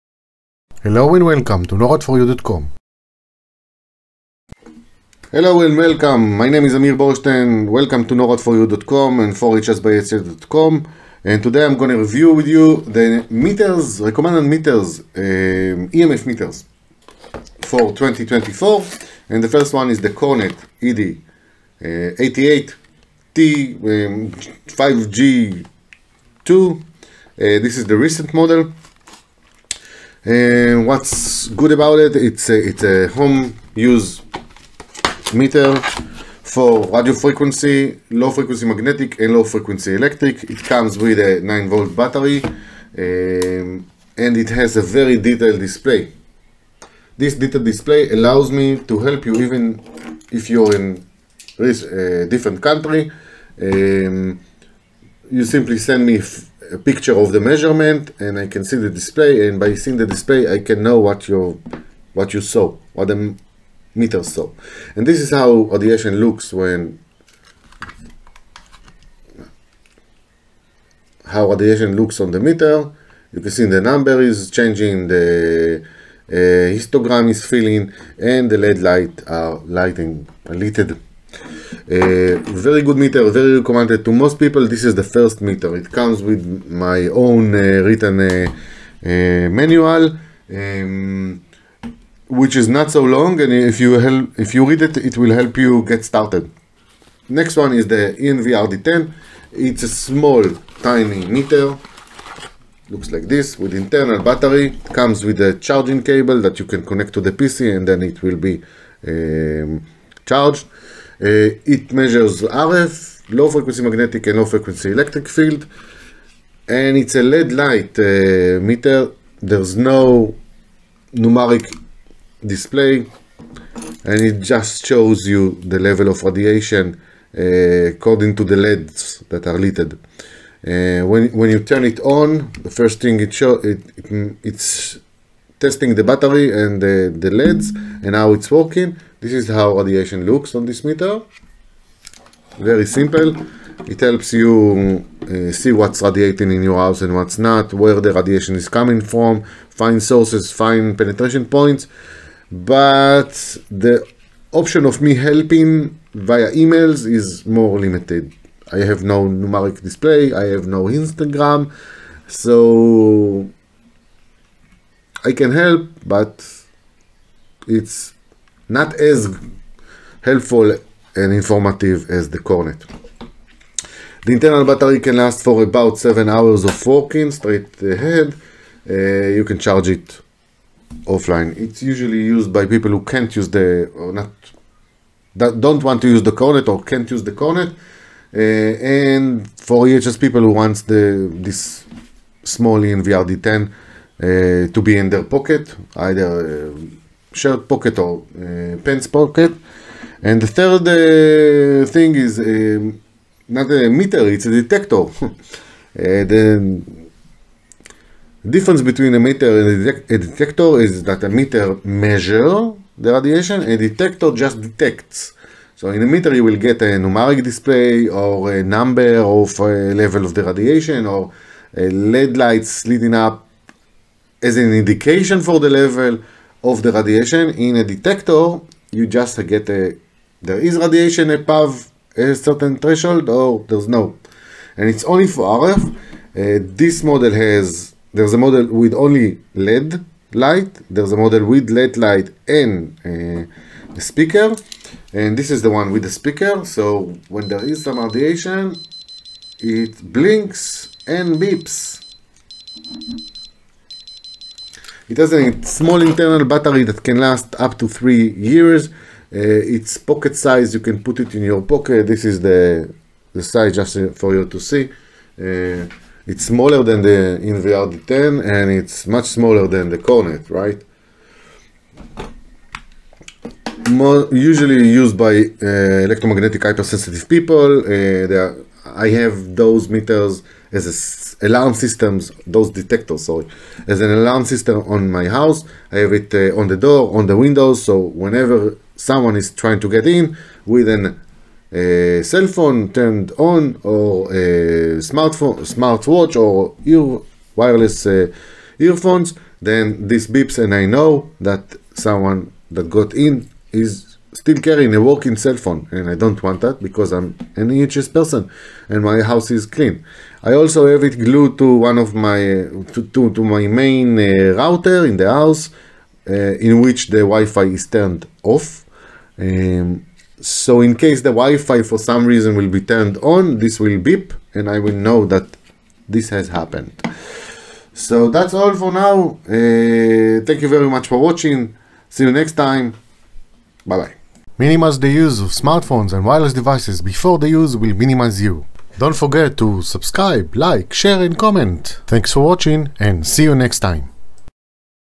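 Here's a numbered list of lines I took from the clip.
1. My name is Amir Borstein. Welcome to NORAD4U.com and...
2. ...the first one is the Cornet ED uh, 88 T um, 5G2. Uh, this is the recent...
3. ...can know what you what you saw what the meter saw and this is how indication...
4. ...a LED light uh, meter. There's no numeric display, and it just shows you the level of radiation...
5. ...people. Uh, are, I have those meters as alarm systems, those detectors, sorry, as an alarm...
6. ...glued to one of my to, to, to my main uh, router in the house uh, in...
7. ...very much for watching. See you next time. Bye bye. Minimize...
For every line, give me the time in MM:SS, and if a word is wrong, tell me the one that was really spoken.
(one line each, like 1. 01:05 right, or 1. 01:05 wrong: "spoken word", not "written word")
1. 00:06 right
2. 00:19 right
3. 01:00 wrong: "radiation", not "indication"
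4. 01:57 right
5. 04:37 right
6. 05:11 right
7. 05:30 right.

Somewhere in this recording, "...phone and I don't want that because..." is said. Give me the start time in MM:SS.
05:05.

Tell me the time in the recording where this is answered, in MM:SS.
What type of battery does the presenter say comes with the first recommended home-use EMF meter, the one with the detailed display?
00:41.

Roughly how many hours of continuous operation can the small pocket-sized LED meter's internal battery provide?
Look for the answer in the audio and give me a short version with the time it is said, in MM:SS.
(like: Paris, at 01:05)
7 hours, at 02:55.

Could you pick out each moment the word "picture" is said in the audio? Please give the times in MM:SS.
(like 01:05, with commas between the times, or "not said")
00:56.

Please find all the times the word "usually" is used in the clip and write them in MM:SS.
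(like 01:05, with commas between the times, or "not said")
03:01, 04:34.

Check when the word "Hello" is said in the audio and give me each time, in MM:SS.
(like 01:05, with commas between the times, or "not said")
00:00, 00:05.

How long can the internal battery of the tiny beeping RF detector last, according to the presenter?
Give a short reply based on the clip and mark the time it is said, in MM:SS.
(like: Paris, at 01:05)
three years, at 04:17.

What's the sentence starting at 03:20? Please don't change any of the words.
And the third uh, thing is uh, not a meter, it's a detector.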